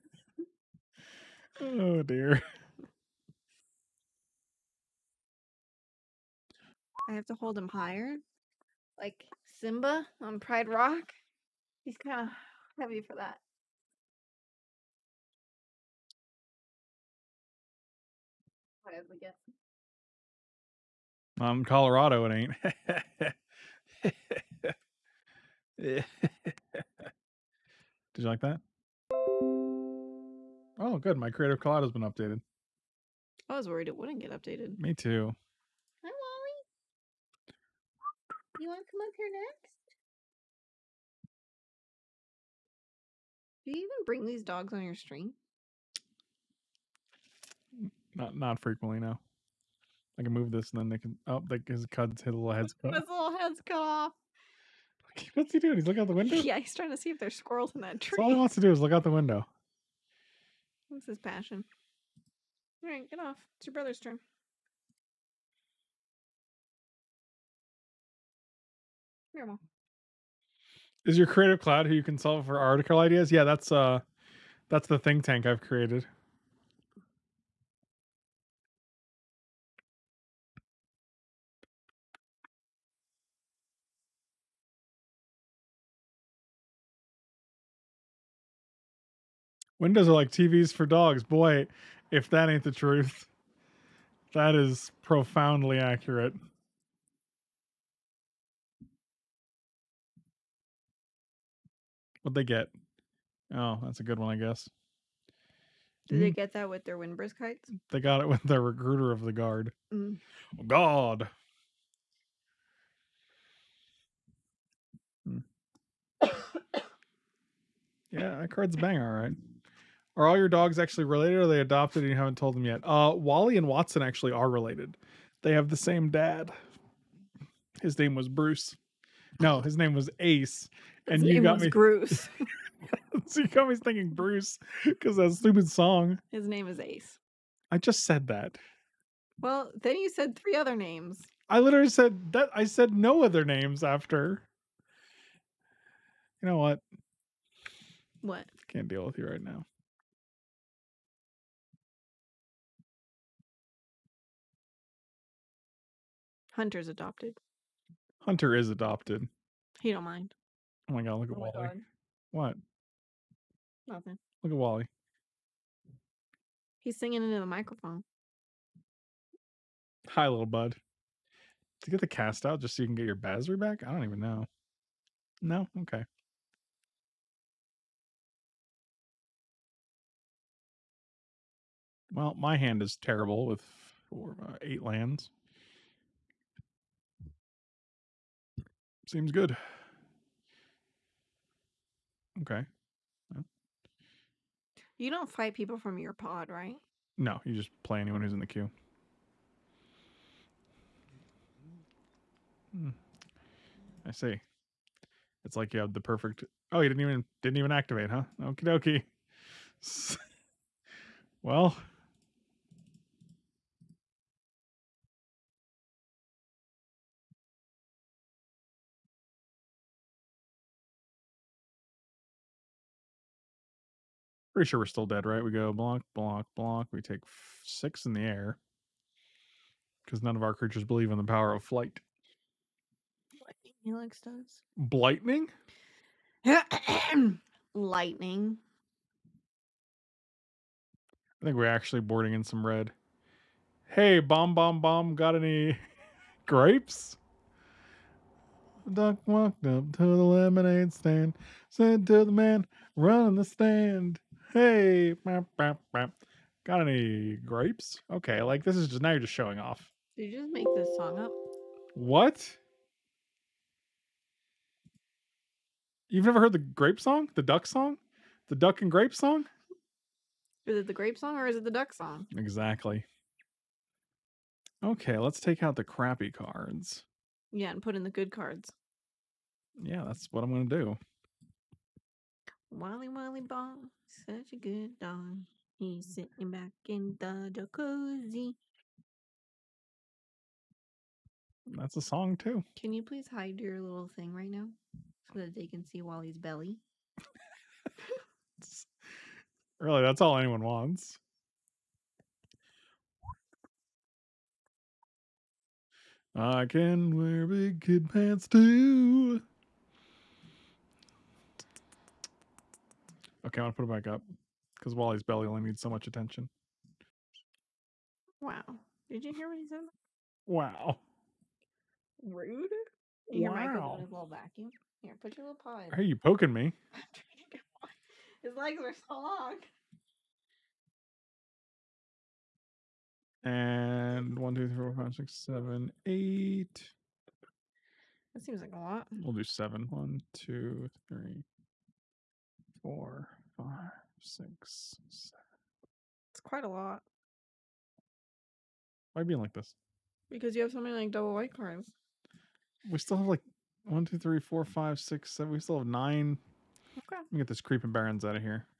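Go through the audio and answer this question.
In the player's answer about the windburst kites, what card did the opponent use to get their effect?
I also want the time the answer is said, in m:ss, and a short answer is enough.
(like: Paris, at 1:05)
Recruiter of the Guard, at 1:48.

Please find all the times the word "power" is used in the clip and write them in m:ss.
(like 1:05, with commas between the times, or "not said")
3:51.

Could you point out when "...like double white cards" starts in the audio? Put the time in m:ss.
5:50.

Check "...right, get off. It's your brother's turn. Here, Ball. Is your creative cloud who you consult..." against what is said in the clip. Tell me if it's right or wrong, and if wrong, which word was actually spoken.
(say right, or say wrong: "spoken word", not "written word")
wrong: "Mom", not "Ball".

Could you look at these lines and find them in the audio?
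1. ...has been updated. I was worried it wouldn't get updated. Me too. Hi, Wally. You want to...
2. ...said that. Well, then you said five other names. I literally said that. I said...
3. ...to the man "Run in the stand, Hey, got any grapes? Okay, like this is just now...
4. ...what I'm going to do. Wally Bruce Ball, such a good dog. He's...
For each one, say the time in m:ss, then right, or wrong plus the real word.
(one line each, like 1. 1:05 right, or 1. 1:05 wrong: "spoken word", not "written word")
1. 0:31 right
2. 2:18 wrong: "three", not "five"
3. 4:12 right
4. 4:40 wrong: "Wally", not "Bruce".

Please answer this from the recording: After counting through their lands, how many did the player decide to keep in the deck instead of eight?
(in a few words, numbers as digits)
7.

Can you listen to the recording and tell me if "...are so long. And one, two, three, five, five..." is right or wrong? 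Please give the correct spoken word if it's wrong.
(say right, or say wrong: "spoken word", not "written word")
wrong: "four", not "five".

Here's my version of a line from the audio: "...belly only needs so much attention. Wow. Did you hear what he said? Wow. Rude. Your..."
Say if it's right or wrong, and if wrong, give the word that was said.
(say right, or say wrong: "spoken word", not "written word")
right.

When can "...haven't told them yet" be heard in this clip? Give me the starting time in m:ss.
2:02.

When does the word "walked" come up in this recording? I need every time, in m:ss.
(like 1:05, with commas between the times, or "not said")
4:09.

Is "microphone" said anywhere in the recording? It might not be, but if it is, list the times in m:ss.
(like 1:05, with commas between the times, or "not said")
2:47, 5:23.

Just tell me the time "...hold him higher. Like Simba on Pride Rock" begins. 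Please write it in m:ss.
0:07.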